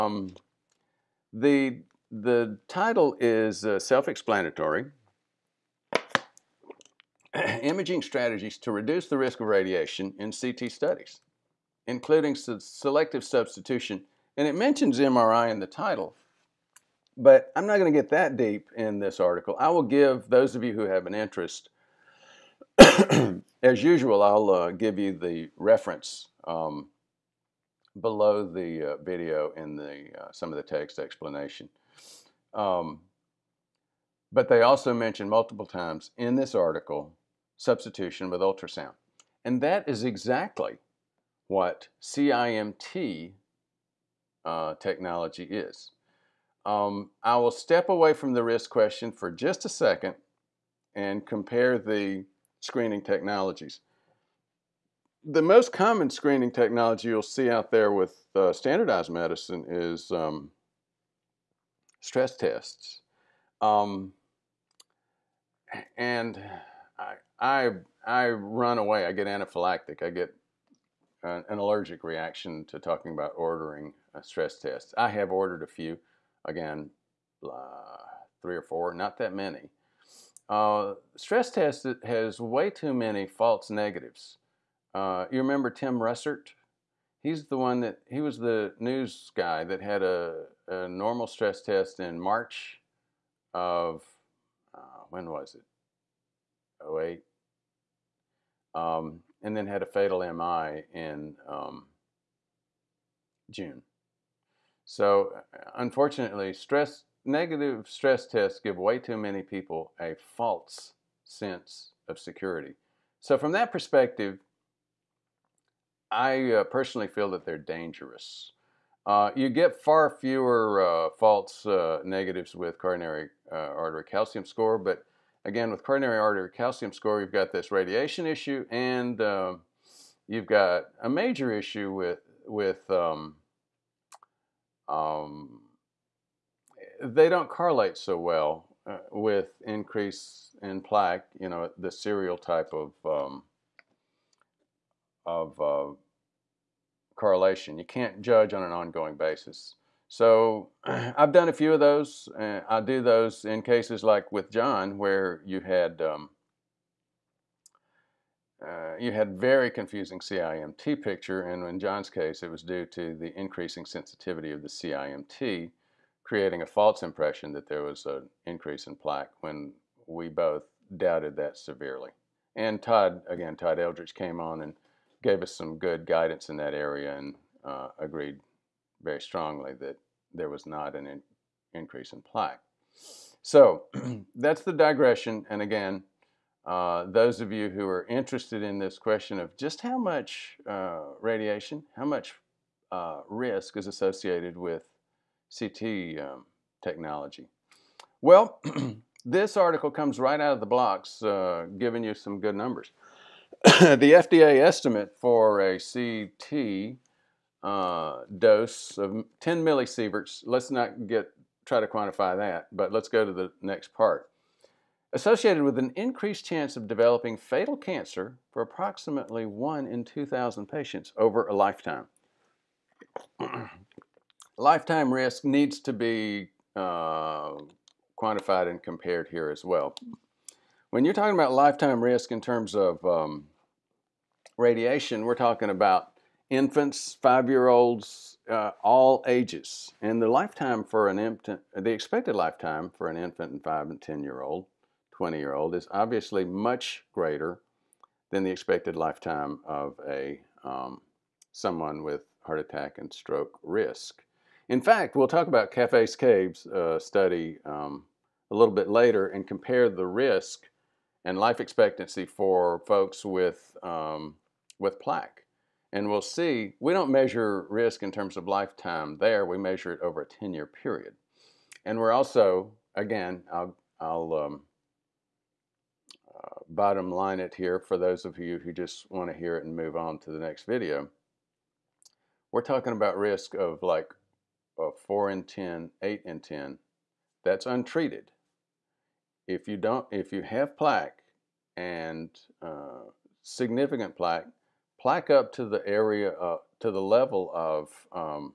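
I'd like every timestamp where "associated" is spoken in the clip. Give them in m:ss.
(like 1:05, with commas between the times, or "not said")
3:13, 3:35.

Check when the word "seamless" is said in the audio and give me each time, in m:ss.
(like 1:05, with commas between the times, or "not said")
not said.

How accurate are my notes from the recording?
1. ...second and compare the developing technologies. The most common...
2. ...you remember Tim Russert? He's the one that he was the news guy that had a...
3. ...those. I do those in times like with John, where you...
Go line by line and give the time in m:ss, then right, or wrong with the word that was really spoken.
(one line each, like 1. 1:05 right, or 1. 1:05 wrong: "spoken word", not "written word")
1. 0:49 wrong: "screening", not "developing"
2. 1:25 right
3. 2:31 wrong: "cases", not "times".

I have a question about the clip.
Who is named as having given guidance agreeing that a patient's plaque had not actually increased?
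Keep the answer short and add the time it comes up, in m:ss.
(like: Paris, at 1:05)
Todd Eldridge, at 2:53.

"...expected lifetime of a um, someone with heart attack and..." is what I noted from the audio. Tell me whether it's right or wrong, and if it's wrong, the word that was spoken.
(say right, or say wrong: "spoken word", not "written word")
right.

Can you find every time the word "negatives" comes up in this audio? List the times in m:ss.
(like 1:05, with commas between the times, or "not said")
1:23, 1:47, 2:02.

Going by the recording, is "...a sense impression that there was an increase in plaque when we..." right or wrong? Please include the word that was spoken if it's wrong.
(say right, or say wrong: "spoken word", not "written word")
wrong: "false", not "sense".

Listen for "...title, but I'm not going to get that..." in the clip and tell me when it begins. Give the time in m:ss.
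0:15.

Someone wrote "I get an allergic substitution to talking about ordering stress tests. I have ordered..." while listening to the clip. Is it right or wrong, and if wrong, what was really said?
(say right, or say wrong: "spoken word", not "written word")
wrong: "reaction", not "substitution".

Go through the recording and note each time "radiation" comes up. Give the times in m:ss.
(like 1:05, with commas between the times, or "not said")
0:09, 2:07, 3:11, 3:54.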